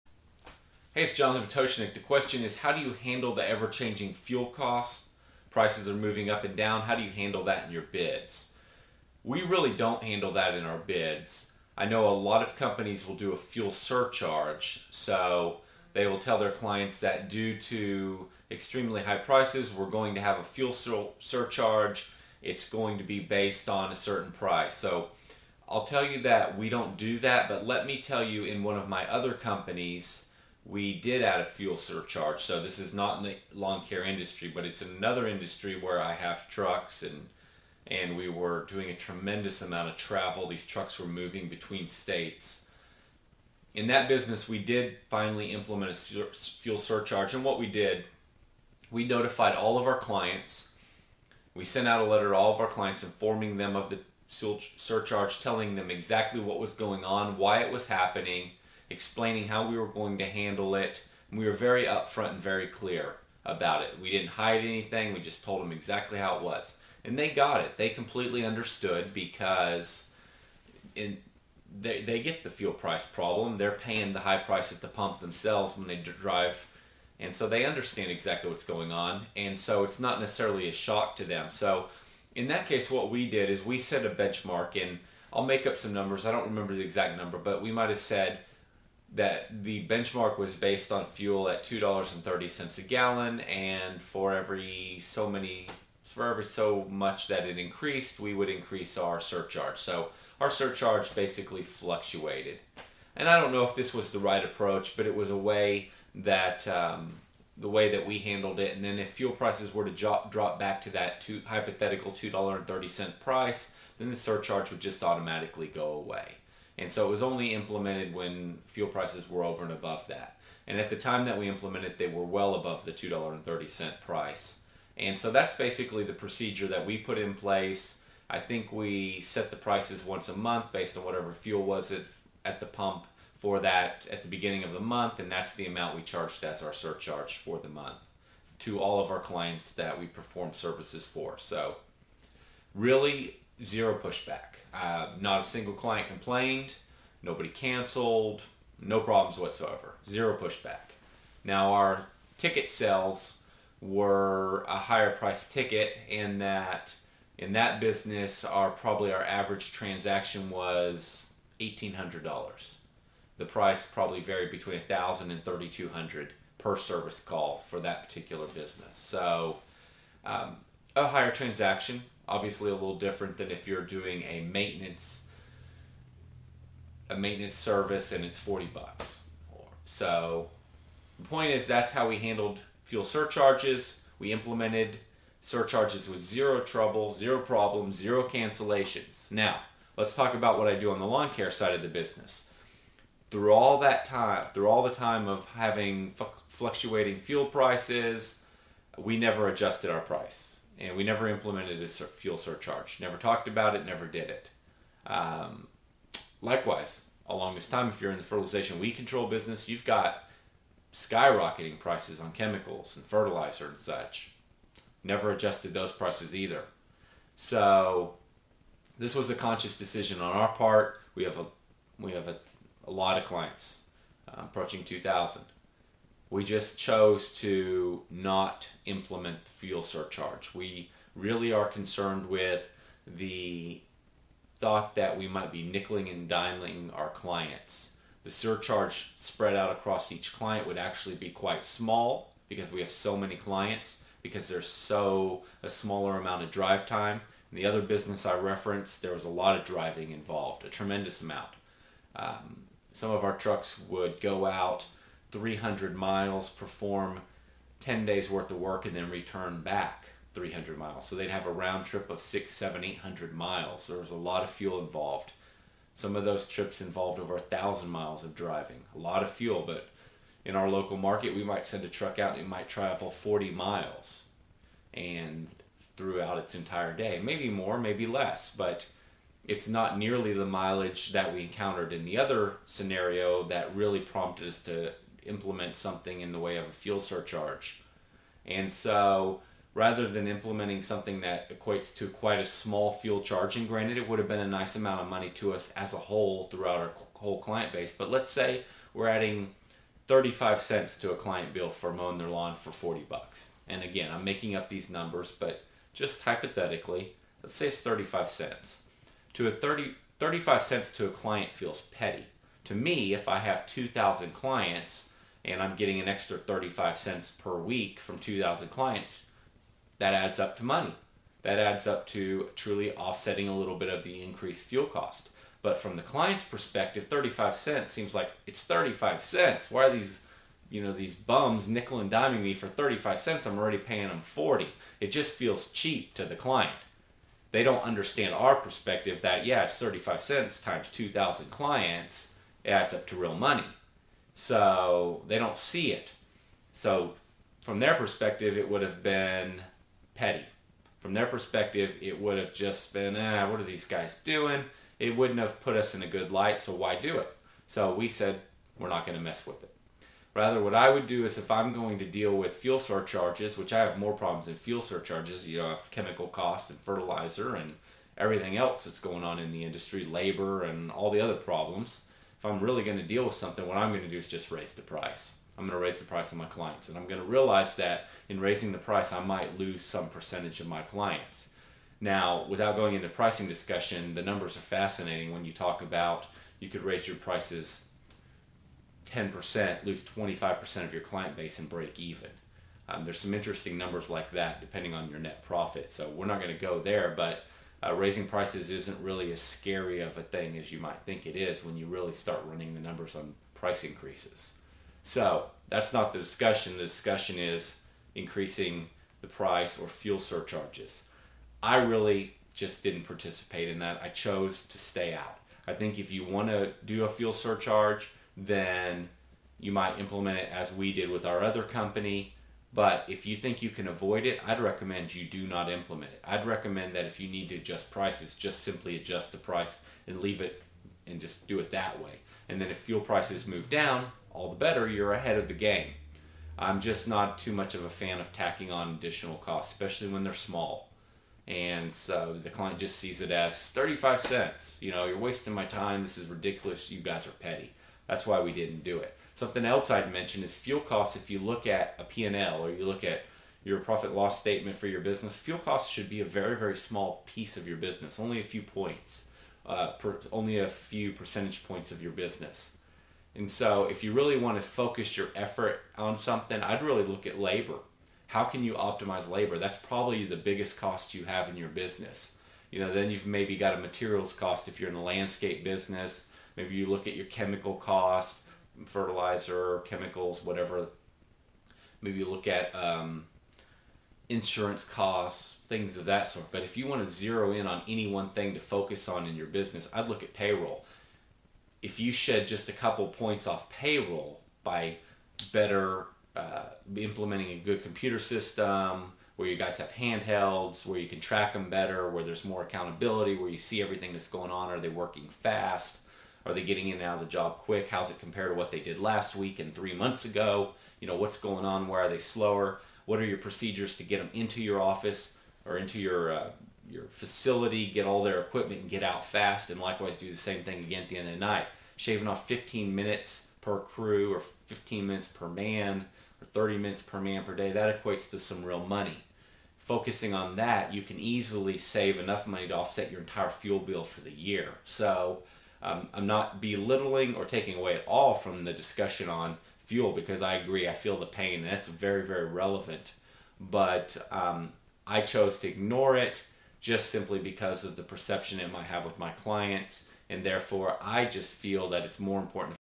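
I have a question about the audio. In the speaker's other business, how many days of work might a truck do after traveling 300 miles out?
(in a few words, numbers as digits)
10 days.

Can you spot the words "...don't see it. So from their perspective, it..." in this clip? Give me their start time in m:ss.
5:45.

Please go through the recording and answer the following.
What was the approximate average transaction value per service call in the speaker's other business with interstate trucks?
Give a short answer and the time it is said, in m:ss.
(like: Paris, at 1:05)
$1,800, at 2:41.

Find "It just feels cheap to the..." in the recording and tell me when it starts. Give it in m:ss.
5:34.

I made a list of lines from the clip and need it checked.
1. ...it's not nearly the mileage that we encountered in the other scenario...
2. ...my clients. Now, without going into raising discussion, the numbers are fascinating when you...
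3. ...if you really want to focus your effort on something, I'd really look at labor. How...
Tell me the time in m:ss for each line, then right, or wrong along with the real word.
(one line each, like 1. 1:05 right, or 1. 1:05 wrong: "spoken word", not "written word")
1. 4:39 right
2. 6:20 wrong: "pricing", not "raising"
3. 7:43 right.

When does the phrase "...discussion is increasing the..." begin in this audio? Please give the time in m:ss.
6:46.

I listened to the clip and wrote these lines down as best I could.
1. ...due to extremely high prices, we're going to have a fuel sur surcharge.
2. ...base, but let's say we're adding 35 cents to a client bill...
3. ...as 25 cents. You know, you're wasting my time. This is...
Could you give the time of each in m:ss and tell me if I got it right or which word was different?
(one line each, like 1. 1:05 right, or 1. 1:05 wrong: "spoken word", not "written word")
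1. 0:17 right
2. 4:57 right
3. 7:23 wrong: "35", not "25".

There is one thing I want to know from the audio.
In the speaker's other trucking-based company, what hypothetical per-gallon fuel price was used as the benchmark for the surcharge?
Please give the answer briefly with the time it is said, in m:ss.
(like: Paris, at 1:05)
$2.30, at 1:31.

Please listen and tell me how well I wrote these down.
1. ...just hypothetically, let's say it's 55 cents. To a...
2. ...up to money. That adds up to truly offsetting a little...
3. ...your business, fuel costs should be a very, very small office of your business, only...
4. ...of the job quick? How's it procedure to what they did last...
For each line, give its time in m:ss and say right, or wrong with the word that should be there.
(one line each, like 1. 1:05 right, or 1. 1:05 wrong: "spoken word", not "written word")
1. 5:05 wrong: "35", not "55"
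2. 5:20 right
3. 7:34 wrong: "piece", not "office"
4. 8:27 wrong: "compare", not "procedure".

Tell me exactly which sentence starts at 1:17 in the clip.
And so they understand exactly what's going on.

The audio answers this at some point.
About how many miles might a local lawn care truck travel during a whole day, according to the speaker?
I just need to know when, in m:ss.
4:33.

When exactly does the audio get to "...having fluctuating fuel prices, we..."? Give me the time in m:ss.
3:15.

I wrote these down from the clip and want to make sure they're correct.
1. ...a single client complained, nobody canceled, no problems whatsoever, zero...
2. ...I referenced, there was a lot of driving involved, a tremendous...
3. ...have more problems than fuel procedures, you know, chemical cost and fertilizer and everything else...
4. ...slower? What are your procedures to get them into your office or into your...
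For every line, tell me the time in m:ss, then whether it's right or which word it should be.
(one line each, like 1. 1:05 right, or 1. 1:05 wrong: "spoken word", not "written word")
1. 2:25 right
2. 4:08 right
3. 6:03 wrong: "surcharges", not "procedures"
4. 8:32 right.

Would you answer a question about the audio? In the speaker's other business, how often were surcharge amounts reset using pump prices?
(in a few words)
Once a month.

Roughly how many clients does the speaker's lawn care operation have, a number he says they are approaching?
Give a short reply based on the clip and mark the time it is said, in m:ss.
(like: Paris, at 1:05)
2,000, at 3:44.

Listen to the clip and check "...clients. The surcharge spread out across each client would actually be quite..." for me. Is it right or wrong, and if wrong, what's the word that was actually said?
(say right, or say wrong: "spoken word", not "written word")
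right.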